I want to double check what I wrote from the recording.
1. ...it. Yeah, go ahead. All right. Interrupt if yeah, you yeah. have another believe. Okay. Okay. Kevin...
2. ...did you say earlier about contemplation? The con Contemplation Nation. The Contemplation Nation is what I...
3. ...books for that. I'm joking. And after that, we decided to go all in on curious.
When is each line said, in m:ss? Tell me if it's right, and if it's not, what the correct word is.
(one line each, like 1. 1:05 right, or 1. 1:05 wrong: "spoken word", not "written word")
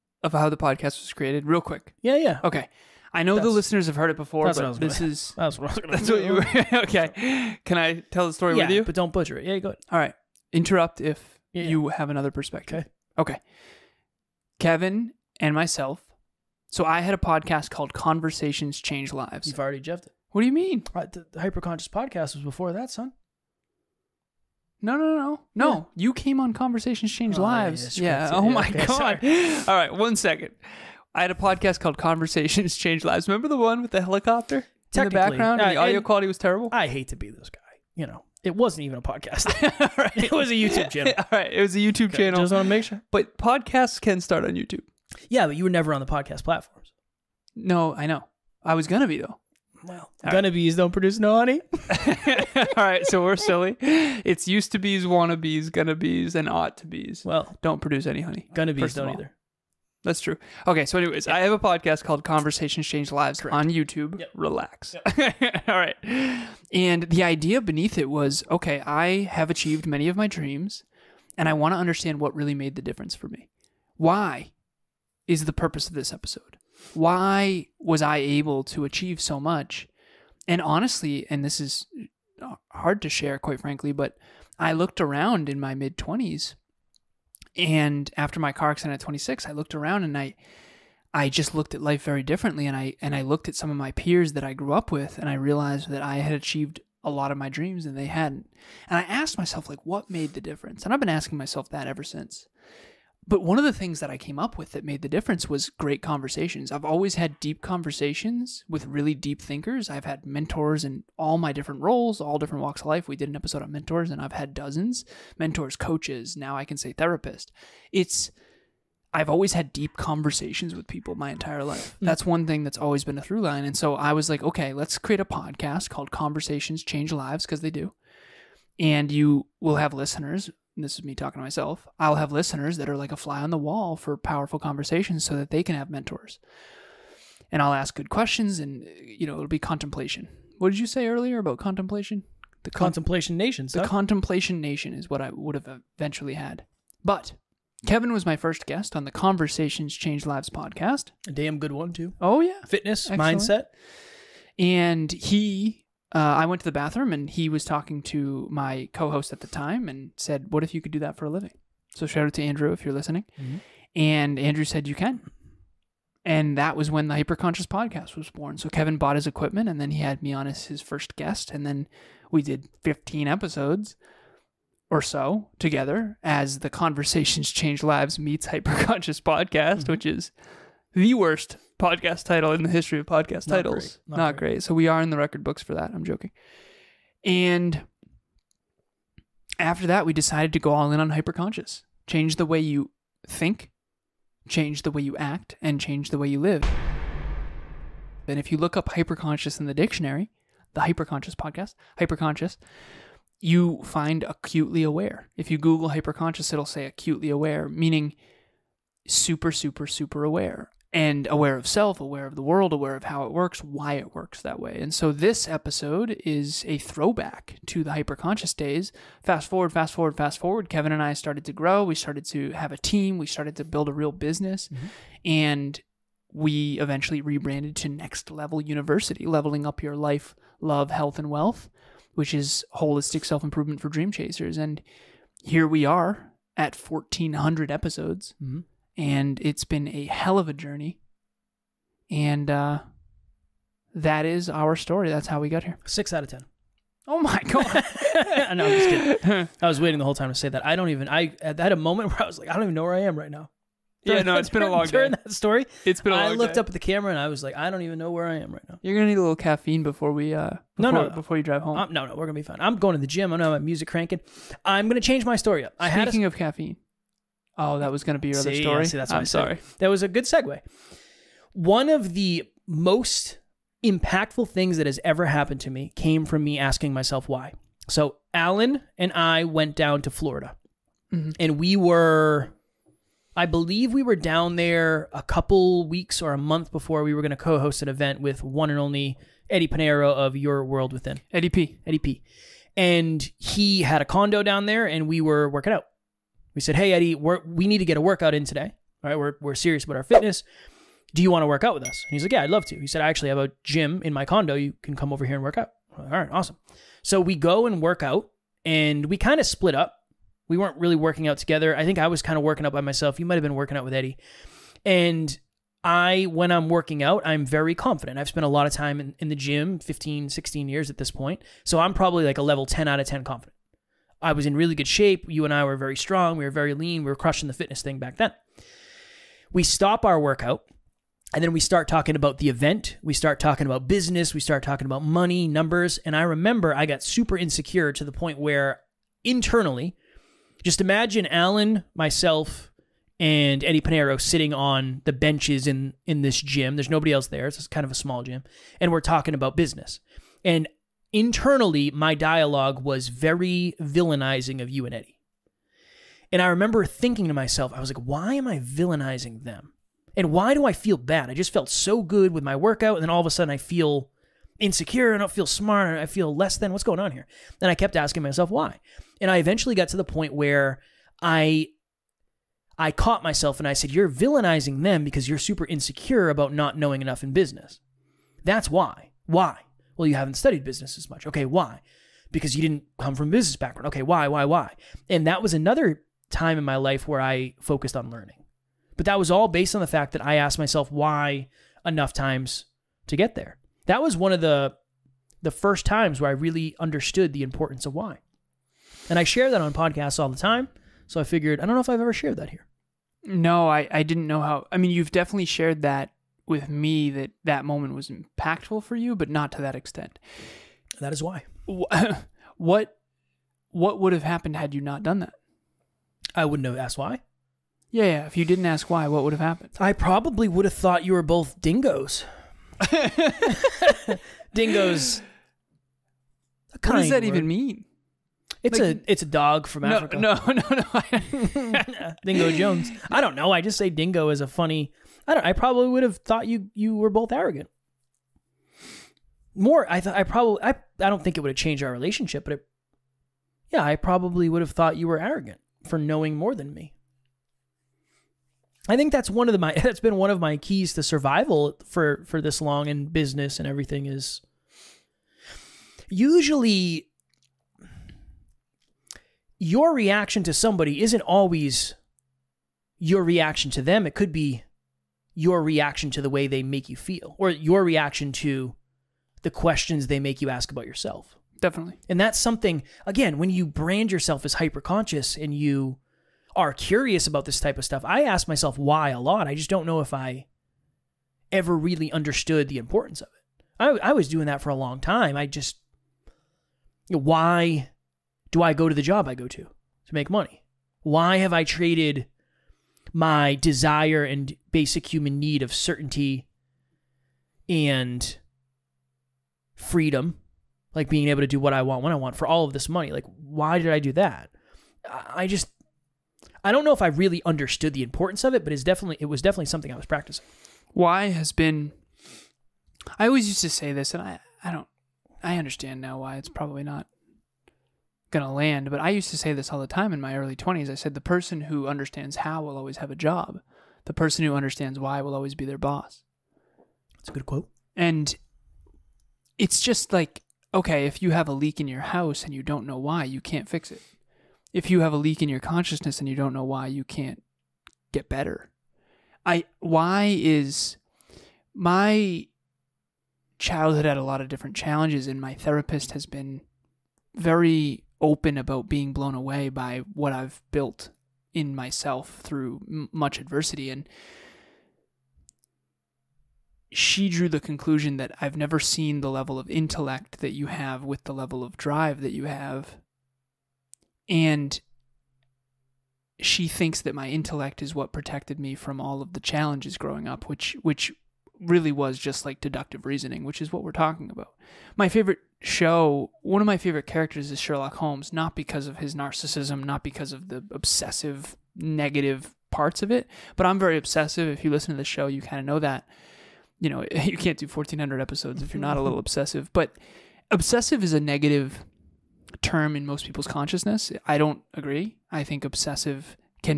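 1. 0:09 wrong: "perspective", not "believe"
2. 2:20 right
3. 3:05 wrong: "hyperconscious", not "curious".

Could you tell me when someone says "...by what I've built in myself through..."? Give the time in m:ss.
9:09.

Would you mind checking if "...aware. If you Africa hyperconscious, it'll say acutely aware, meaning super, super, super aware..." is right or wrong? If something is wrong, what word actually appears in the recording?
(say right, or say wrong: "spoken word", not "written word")
wrong: "Google", not "Africa".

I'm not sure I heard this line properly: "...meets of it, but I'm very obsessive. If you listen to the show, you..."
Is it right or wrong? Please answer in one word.
wrong.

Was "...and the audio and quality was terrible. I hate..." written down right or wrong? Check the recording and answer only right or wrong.
right.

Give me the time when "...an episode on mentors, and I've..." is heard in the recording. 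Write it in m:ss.
1:53.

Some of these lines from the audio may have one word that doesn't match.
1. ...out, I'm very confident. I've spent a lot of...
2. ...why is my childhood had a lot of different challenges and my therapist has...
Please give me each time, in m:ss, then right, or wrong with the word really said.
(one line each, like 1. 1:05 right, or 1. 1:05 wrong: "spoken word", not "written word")
1. 5:17 right
2. 8:59 right.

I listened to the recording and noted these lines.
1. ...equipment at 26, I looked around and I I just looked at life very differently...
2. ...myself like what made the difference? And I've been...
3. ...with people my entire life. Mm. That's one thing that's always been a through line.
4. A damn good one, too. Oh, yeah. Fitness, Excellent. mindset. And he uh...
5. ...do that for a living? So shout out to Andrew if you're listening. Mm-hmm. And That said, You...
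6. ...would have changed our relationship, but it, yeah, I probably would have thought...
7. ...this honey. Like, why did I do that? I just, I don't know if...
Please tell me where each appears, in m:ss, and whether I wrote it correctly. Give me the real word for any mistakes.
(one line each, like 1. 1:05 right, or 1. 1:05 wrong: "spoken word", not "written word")
1. 1:28 wrong: "accident", not "equipment"
2. 1:39 right
3. 2:00 right
4. 2:31 right
5. 2:40 wrong: "Andrew", not "That"
6. 7:21 right
7. 8:22 wrong: "money", not "honey".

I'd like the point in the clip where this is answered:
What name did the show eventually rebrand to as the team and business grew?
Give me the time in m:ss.
3:47.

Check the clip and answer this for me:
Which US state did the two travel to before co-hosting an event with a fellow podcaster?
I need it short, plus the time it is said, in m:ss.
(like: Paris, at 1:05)
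Florida, at 4:40.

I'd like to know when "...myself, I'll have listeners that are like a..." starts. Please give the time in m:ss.
2:11.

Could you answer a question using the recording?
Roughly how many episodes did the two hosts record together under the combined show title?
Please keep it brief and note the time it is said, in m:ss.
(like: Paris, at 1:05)
15, at 2:52.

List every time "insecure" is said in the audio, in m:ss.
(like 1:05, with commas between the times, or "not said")
5:37, 6:04, 6:15.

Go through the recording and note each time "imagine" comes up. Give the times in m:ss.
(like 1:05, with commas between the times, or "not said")
5:40.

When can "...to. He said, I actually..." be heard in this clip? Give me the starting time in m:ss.
5:02.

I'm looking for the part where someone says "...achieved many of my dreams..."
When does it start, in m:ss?
1:09.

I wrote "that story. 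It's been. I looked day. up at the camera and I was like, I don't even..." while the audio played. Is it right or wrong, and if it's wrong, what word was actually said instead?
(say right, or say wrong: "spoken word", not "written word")
right.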